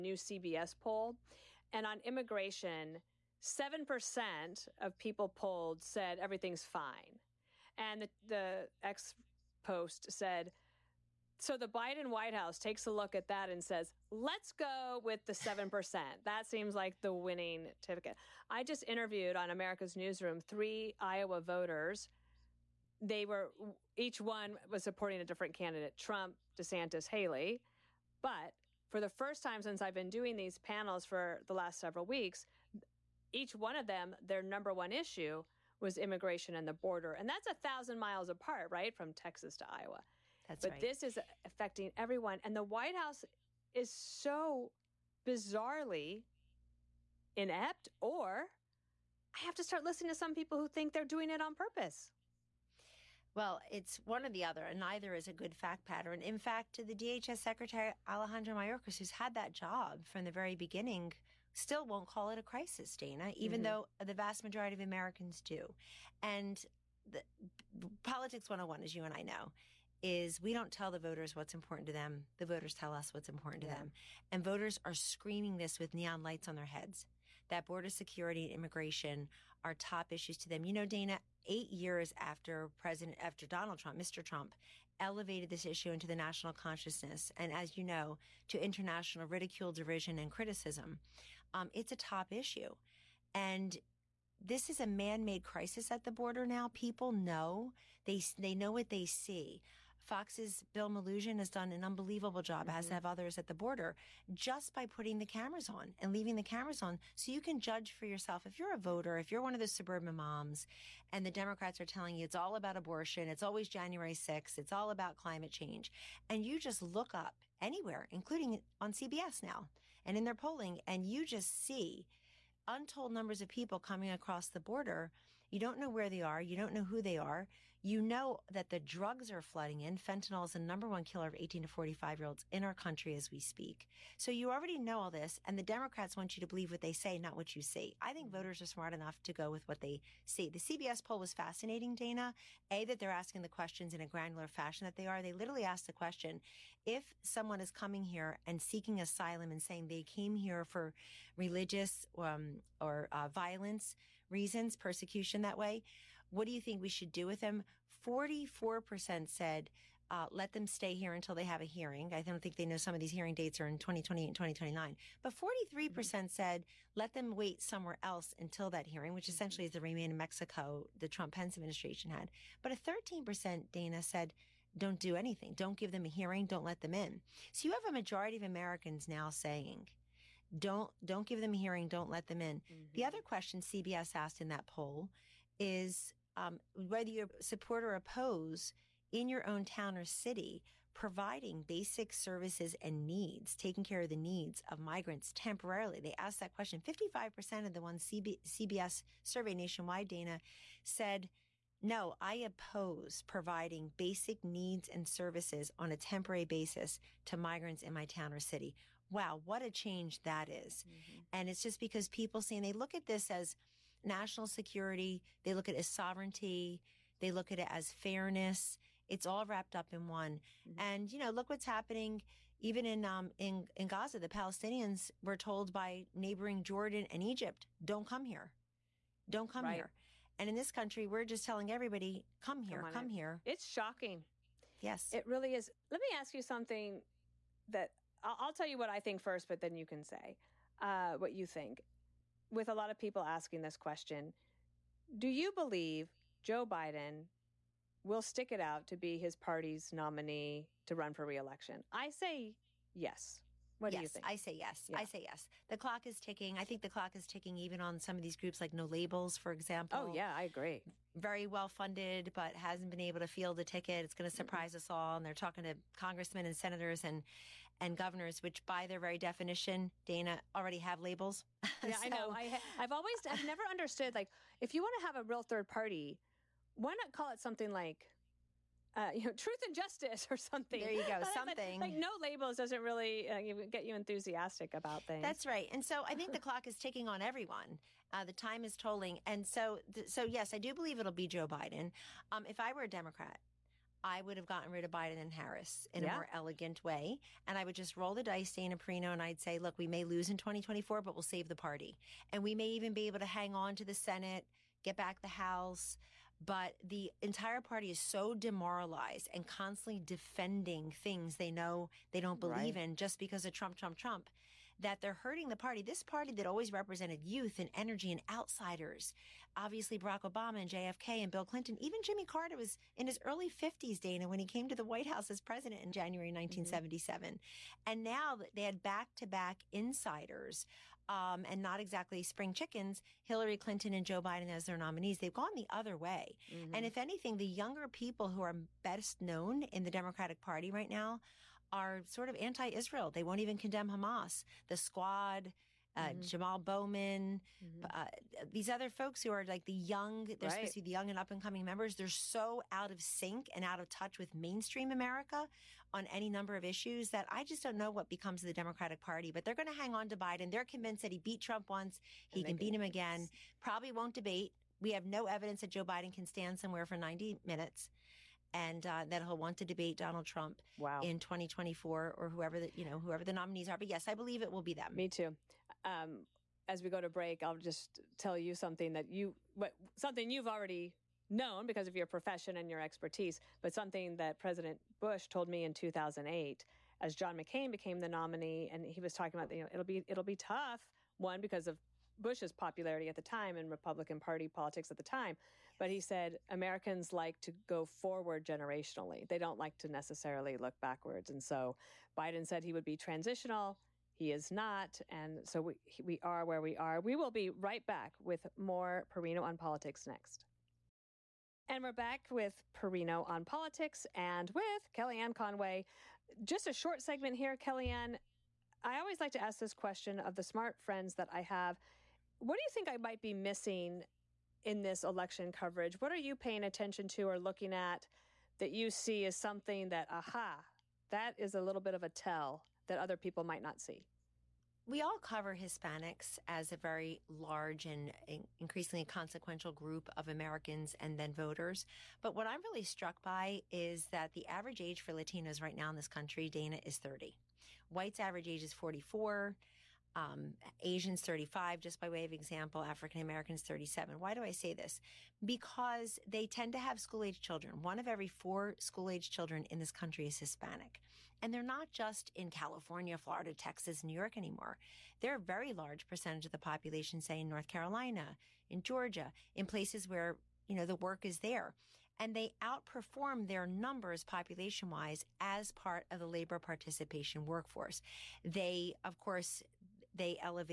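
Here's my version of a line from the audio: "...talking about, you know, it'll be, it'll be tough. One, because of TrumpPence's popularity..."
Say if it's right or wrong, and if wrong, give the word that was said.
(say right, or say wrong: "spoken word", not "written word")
wrong: "Bush", not "TrumpPence".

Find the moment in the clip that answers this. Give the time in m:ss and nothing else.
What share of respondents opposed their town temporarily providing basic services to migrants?
3:16.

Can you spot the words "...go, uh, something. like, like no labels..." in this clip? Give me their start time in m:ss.
4:41.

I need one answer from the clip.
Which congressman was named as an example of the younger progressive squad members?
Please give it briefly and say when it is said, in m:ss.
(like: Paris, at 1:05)
Jamal Bowman, at 5:46.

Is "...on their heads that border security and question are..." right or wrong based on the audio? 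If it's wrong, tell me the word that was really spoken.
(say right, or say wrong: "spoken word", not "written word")
wrong: "immigration", not "question".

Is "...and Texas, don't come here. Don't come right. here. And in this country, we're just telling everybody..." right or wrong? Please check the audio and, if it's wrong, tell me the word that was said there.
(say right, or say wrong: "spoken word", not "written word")
wrong: "Egypt", not "Texas".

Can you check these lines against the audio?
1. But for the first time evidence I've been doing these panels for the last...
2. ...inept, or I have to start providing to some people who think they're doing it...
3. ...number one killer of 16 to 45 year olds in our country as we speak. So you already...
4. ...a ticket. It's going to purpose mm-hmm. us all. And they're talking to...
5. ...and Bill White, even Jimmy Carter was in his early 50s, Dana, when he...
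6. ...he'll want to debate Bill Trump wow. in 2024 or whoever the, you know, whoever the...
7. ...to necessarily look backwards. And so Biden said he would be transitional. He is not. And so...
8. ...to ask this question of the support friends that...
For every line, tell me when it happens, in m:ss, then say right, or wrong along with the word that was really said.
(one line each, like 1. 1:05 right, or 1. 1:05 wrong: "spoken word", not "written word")
1. 0:28 wrong: "since", not "evidence"
2. 0:47 wrong: "listening", not "providing"
3. 2:10 wrong: "18", not "16"
4. 4:23 wrong: "surprise", not "purpose"
5. 5:21 wrong: "Clinton", not "White"
6. 6:09 wrong: "Donald", not "Bill"
7. 6:39 right
8. 6:59 wrong: "smart", not "support".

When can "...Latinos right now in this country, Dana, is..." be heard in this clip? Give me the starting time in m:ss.
7:25.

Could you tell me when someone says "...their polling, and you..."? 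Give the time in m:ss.
2:00.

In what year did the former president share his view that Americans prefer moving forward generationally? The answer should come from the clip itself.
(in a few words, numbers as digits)
2008.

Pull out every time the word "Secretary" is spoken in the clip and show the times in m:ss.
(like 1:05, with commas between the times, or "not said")
0:57.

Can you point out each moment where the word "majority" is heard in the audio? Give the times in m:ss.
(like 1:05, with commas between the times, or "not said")
1:04, 2:57.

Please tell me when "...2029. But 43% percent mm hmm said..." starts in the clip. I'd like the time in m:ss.
2:44.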